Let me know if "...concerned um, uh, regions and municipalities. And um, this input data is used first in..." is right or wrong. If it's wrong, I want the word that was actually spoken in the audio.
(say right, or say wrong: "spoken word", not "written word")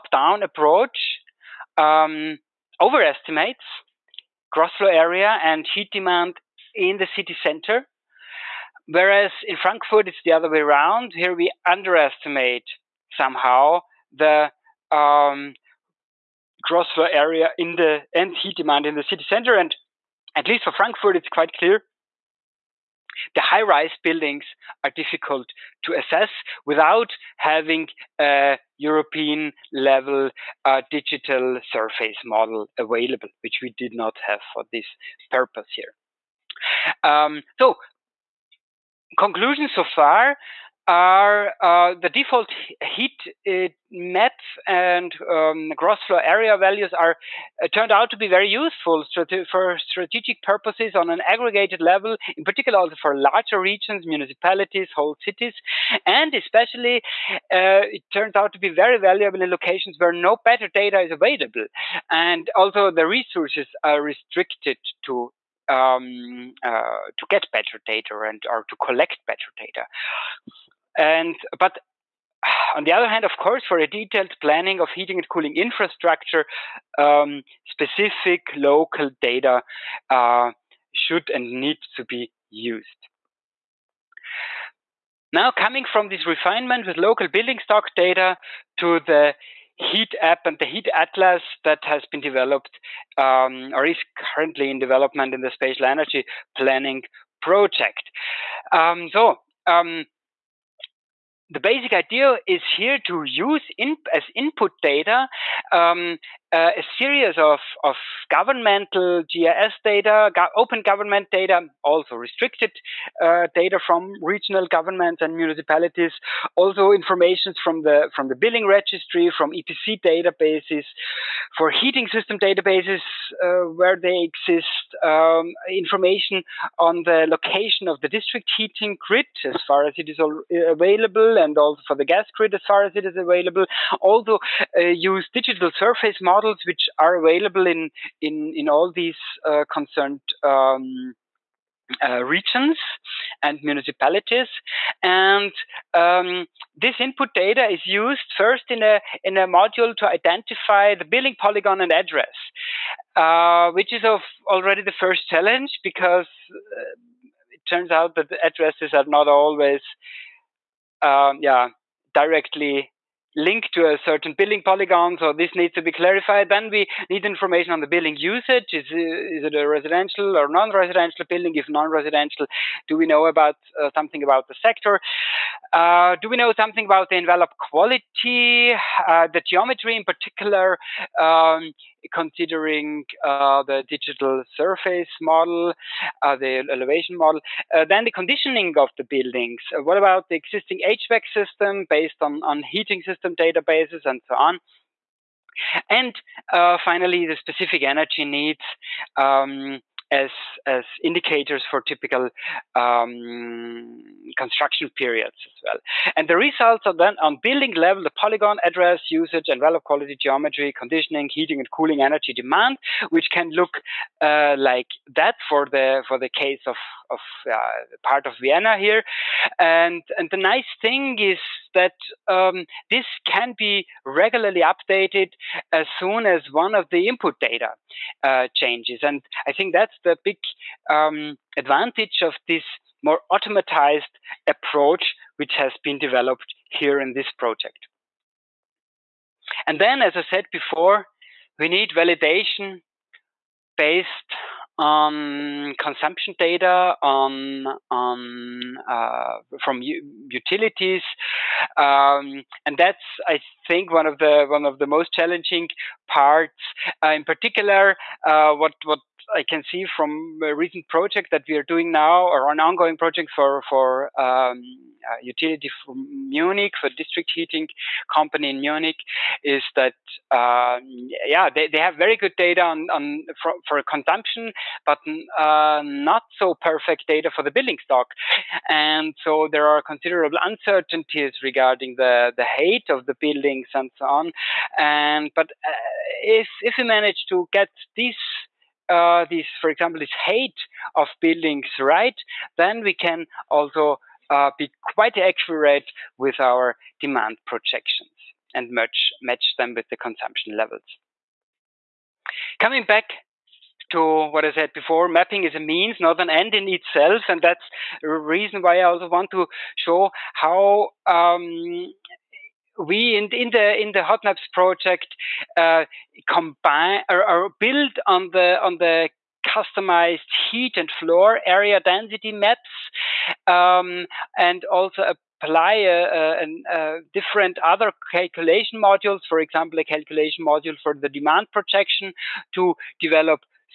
right.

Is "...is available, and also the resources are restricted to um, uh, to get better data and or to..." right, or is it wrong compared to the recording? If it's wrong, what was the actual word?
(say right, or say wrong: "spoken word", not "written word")
right.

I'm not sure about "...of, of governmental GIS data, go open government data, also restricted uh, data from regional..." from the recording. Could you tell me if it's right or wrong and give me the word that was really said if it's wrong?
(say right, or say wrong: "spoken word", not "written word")
right.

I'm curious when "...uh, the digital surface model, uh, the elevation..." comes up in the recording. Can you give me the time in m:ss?
3:03.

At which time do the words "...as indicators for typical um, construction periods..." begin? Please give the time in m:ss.
3:20.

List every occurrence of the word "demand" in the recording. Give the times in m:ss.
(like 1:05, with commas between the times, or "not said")
0:05, 0:18, 3:32, 4:56, 5:31.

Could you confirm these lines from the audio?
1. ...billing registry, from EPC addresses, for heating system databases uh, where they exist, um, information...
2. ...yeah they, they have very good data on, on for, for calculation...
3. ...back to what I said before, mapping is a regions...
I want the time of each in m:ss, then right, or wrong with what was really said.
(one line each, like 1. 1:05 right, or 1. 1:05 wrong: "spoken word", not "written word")
1. 1:58 wrong: "databases", not "addresses"
2. 4:31 wrong: "consumption", not "calculation"
3. 5:02 wrong: "means", not "regions".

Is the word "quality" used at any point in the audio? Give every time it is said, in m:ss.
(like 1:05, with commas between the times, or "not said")
2:57, 3:29.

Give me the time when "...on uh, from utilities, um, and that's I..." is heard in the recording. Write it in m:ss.
4:07.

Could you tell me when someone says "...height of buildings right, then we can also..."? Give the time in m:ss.
4:50.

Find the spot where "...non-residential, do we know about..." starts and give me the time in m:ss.
2:51.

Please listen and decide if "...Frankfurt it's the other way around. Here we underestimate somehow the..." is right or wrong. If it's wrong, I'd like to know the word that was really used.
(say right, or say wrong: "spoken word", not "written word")
right.